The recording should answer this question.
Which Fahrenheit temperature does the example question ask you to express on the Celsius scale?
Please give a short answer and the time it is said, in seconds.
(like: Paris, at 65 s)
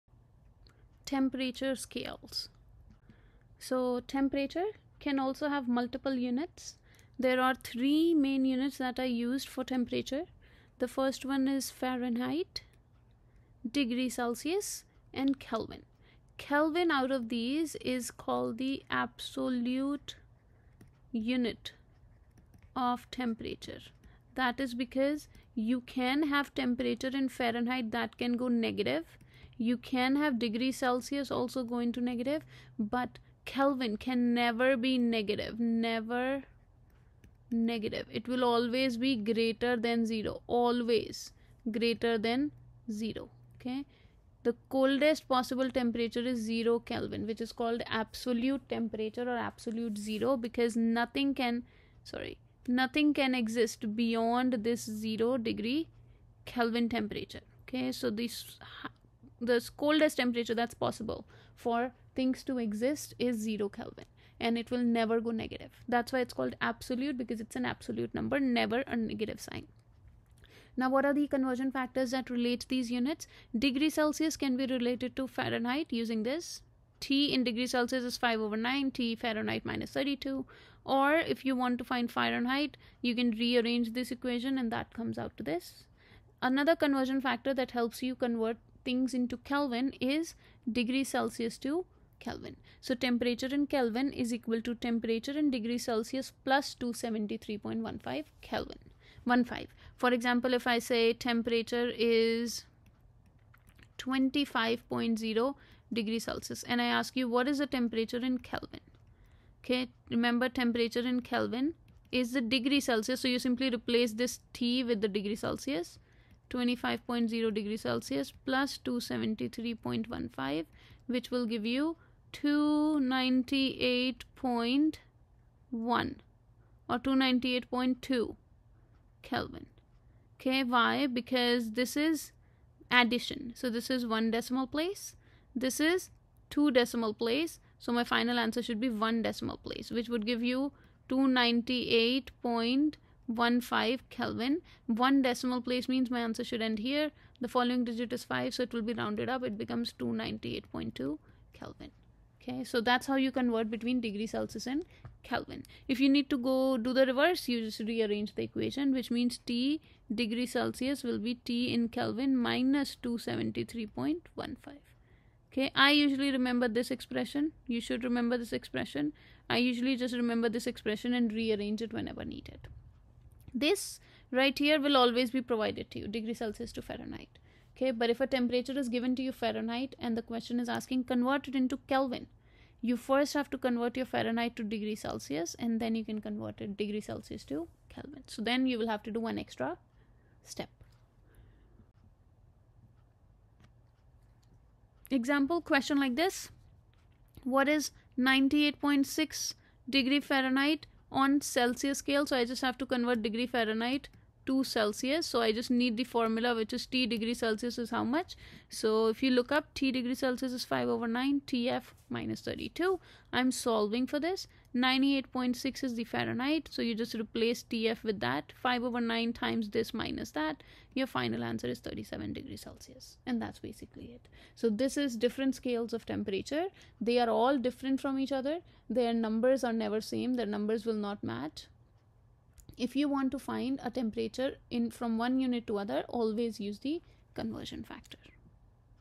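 98.6 degree Fahrenheit, at 198 s.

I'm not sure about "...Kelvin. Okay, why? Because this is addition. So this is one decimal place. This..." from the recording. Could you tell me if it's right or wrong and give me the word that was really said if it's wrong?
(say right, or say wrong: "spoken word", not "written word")
right.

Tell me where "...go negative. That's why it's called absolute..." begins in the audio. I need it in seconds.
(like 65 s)
65 s.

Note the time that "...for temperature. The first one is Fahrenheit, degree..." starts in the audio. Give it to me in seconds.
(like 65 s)
9 s.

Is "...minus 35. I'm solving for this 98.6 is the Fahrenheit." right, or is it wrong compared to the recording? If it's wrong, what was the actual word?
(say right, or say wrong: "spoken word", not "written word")
wrong: "32", not "35".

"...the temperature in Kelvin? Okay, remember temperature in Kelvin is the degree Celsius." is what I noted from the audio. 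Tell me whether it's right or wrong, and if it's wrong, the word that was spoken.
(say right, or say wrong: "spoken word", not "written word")
right.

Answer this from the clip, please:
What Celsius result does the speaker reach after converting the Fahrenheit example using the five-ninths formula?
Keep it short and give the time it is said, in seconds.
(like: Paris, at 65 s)
37 degrees Celsius, at 221 s.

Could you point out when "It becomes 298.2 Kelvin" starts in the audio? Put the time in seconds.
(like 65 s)
149 s.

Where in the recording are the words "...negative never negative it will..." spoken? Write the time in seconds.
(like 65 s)
35 s.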